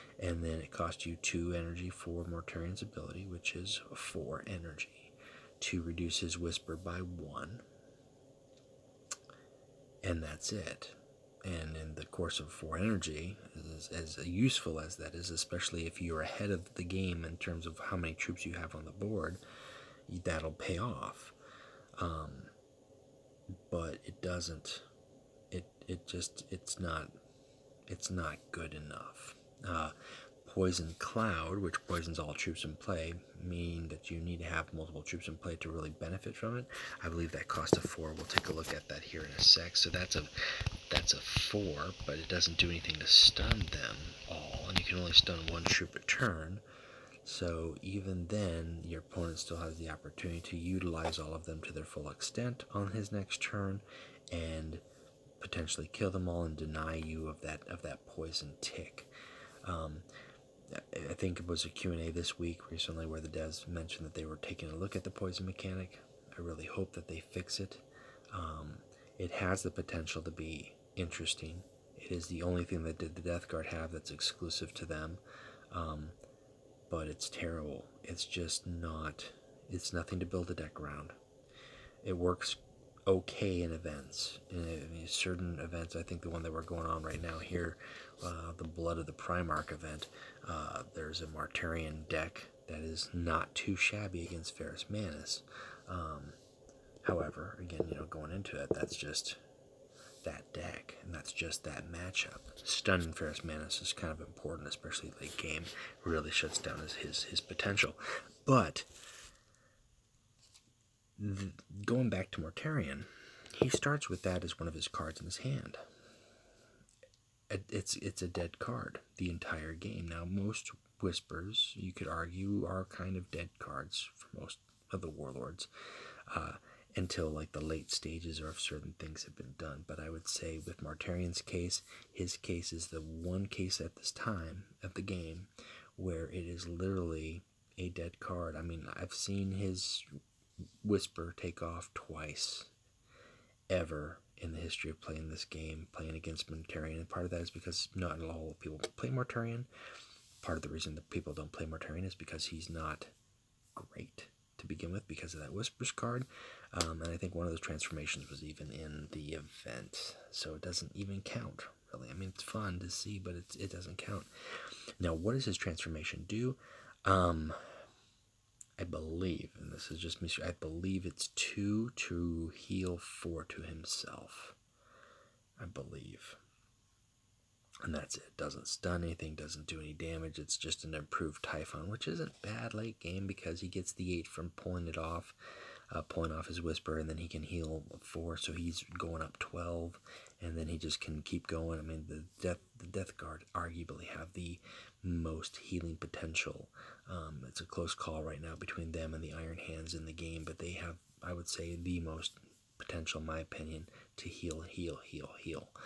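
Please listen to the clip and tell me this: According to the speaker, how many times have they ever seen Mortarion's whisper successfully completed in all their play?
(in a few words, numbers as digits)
2.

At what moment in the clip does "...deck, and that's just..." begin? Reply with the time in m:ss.
1:40.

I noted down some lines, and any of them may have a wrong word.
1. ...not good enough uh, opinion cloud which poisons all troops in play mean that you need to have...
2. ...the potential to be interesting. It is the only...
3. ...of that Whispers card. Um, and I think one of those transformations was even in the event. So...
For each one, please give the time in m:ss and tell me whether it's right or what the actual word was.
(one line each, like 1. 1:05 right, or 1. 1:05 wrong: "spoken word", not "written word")
1. 0:28 wrong: "poison", not "opinion"
2. 1:09 right
3. 2:35 right.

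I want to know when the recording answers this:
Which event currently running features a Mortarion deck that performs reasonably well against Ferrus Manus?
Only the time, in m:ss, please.
1:28.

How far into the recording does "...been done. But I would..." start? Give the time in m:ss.
2:09.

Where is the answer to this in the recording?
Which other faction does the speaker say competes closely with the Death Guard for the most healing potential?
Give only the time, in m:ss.
3:19.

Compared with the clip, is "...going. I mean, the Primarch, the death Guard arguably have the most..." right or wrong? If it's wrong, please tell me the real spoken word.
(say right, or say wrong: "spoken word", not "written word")
wrong: "Death", not "Primarch".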